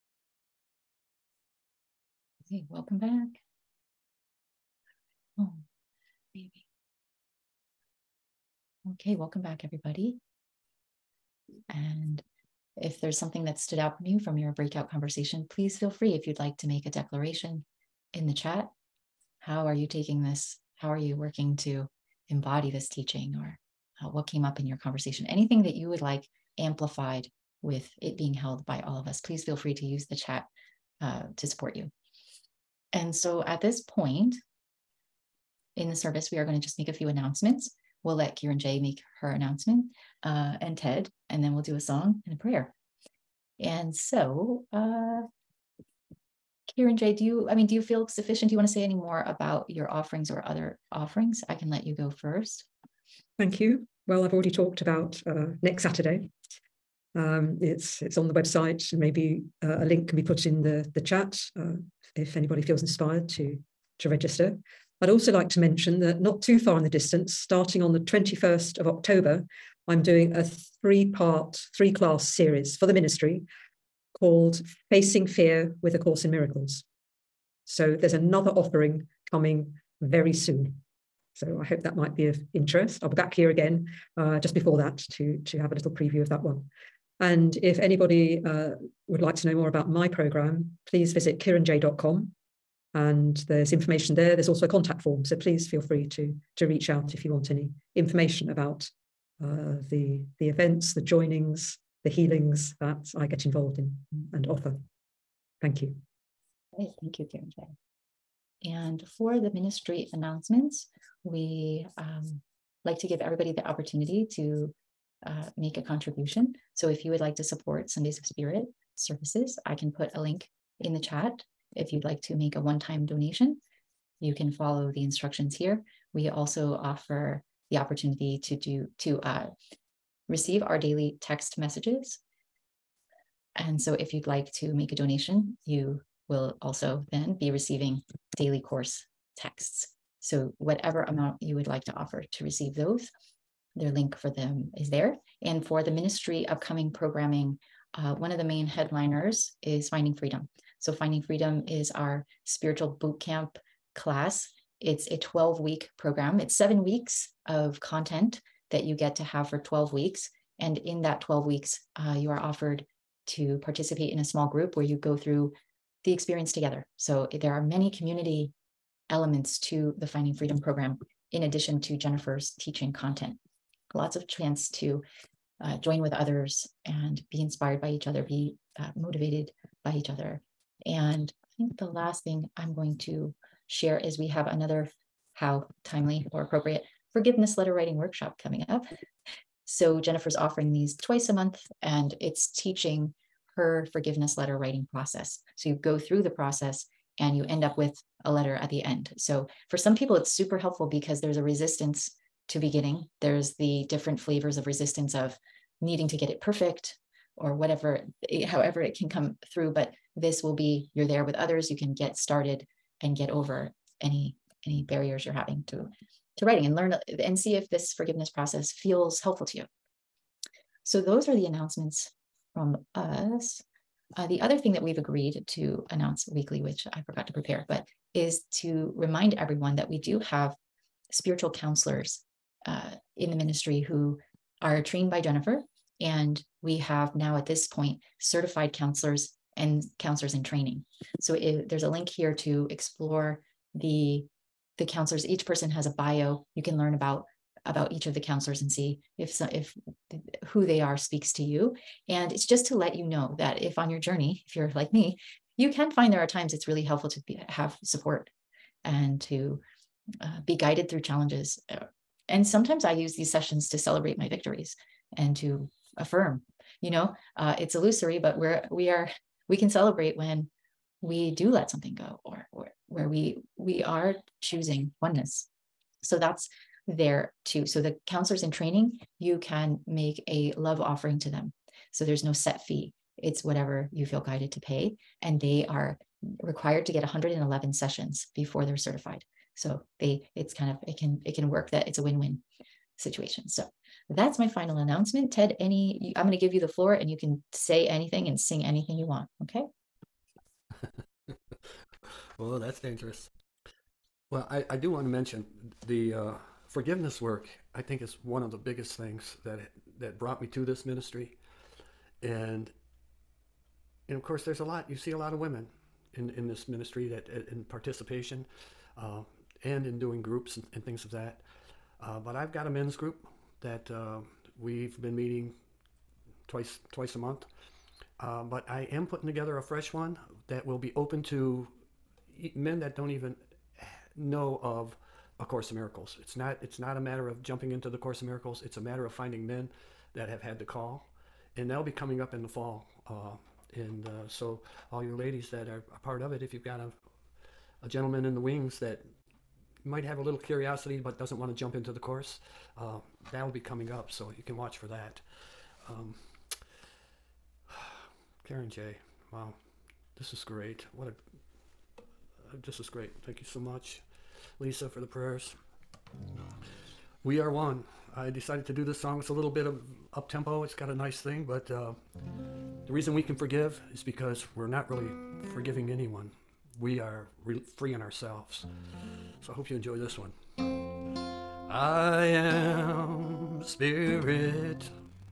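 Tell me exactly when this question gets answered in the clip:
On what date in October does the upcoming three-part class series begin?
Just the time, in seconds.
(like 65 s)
67 s.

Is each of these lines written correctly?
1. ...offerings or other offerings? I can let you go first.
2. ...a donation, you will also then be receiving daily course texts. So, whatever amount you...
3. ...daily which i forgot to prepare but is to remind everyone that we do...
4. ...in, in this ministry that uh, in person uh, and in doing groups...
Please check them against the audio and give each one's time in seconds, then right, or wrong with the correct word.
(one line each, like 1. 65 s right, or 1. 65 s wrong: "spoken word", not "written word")
1. 49 s right
2. 134 s right
3. 226 s wrong: "weekly", not "daily"
4. 316 s wrong: "participation", not "person".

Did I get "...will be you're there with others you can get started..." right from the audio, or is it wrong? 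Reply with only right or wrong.
right.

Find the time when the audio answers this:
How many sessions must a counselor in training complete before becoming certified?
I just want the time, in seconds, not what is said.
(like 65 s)
287 s.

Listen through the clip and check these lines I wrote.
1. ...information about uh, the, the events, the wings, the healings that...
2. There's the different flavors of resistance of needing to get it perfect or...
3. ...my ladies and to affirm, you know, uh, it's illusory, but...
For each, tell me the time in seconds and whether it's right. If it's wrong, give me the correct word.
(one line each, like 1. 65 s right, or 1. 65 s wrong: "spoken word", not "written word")
1. 97 s wrong: "joinings", not "wings"
2. 203 s right
3. 264 s wrong: "victories", not "ladies".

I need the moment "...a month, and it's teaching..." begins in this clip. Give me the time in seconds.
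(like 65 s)
191 s.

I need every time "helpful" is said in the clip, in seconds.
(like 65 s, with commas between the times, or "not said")
200 s, 219 s, 256 s.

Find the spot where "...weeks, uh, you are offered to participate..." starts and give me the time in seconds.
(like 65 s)
161 s.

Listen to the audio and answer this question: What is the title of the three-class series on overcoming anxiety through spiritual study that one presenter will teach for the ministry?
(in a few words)
Facing Fear with A Course in Miracles.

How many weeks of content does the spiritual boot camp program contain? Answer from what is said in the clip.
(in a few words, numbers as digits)
7.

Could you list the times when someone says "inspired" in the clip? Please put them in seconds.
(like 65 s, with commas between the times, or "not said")
62 s, 177 s.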